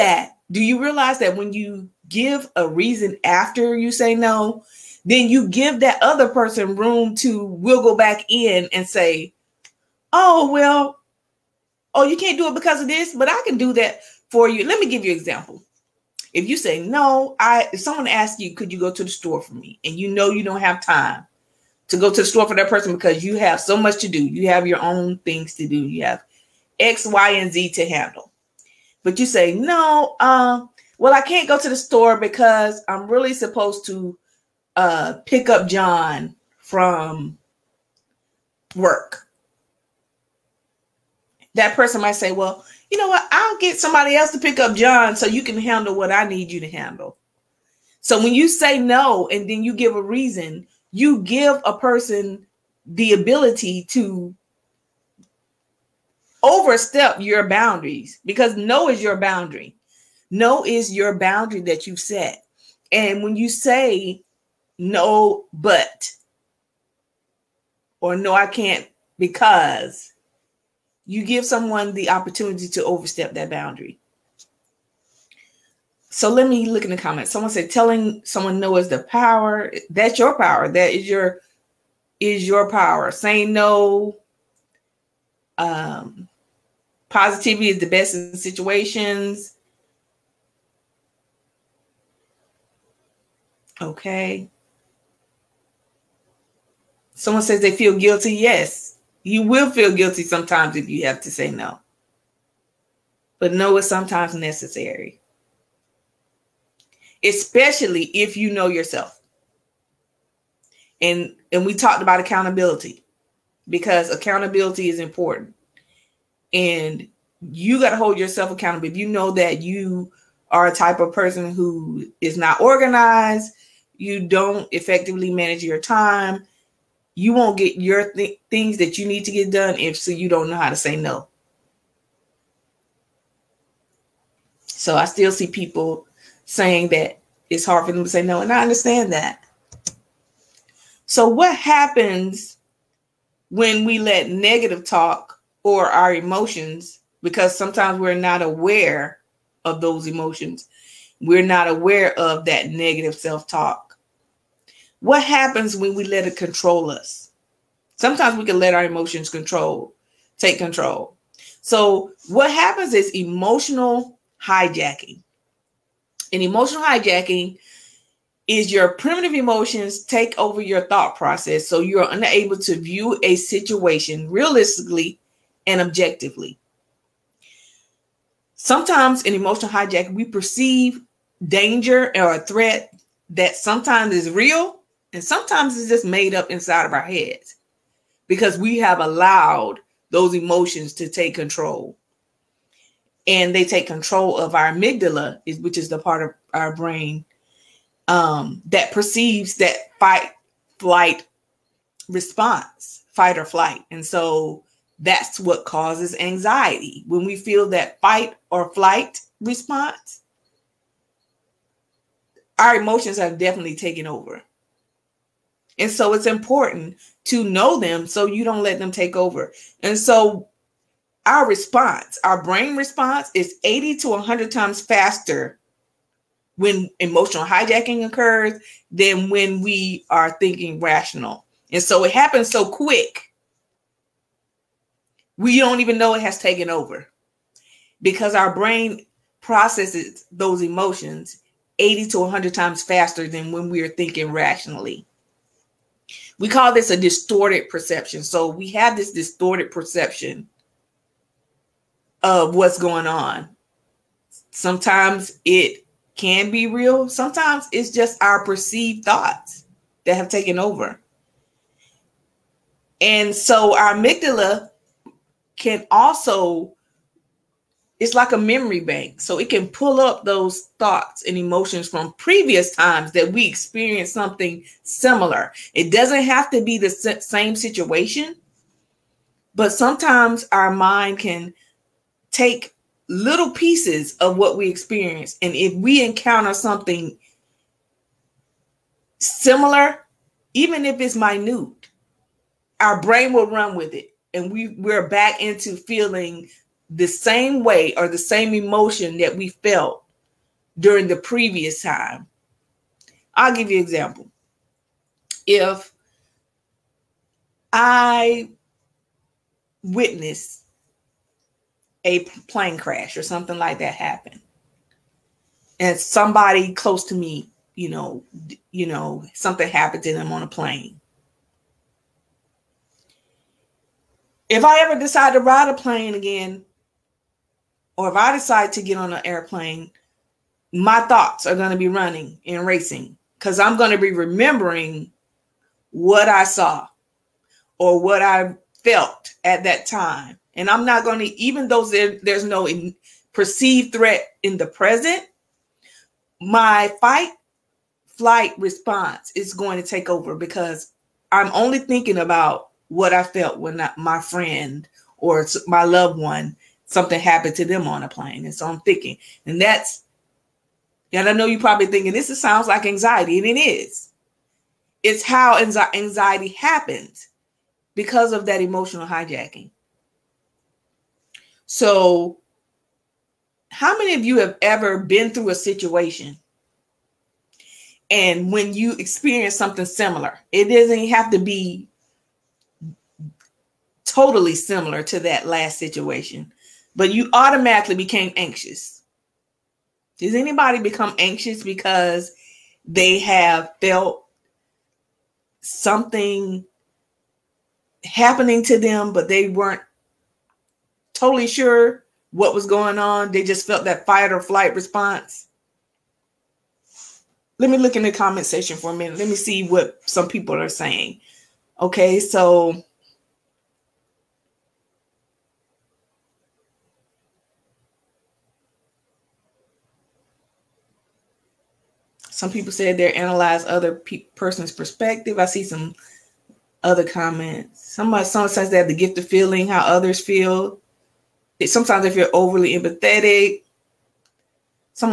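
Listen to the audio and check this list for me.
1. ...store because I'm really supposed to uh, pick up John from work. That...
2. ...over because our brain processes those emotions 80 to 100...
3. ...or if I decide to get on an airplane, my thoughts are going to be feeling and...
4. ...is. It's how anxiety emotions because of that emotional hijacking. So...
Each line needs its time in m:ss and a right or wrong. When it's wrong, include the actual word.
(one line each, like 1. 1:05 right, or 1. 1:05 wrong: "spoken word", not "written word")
1. 0:31 right
2. 3:56 right
3. 5:28 wrong: "running", not "feeling"
4. 6:03 wrong: "happens", not "emotions".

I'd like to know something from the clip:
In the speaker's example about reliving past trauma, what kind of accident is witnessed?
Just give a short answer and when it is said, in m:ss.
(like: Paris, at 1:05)
A plane crash, at 5:12.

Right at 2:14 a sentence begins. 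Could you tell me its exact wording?
So I still see people saying that it's hard for them to say no, and I understand that.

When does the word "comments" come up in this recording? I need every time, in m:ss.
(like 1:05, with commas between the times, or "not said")
1:16, 6:48, 7:07.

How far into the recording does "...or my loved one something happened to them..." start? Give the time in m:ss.
5:55.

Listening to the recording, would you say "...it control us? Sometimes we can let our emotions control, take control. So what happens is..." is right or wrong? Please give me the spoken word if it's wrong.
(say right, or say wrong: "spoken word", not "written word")
right.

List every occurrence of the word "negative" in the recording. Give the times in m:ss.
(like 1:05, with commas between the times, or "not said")
2:24, 2:32.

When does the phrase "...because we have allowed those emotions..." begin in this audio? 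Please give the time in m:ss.
3:08.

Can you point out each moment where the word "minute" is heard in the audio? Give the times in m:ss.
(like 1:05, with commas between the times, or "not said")
4:51, 6:48.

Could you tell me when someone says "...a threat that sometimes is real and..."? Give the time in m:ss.
3:02.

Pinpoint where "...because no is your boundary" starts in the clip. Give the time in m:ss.
0:58.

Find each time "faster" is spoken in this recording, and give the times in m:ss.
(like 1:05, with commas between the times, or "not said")
3:44, 4:02.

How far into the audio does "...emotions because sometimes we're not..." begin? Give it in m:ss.
2:26.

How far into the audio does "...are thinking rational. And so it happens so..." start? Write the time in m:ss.
3:50.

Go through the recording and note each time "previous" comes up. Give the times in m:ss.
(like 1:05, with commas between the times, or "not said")
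4:32, 5:01.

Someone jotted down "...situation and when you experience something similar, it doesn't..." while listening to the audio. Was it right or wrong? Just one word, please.
right.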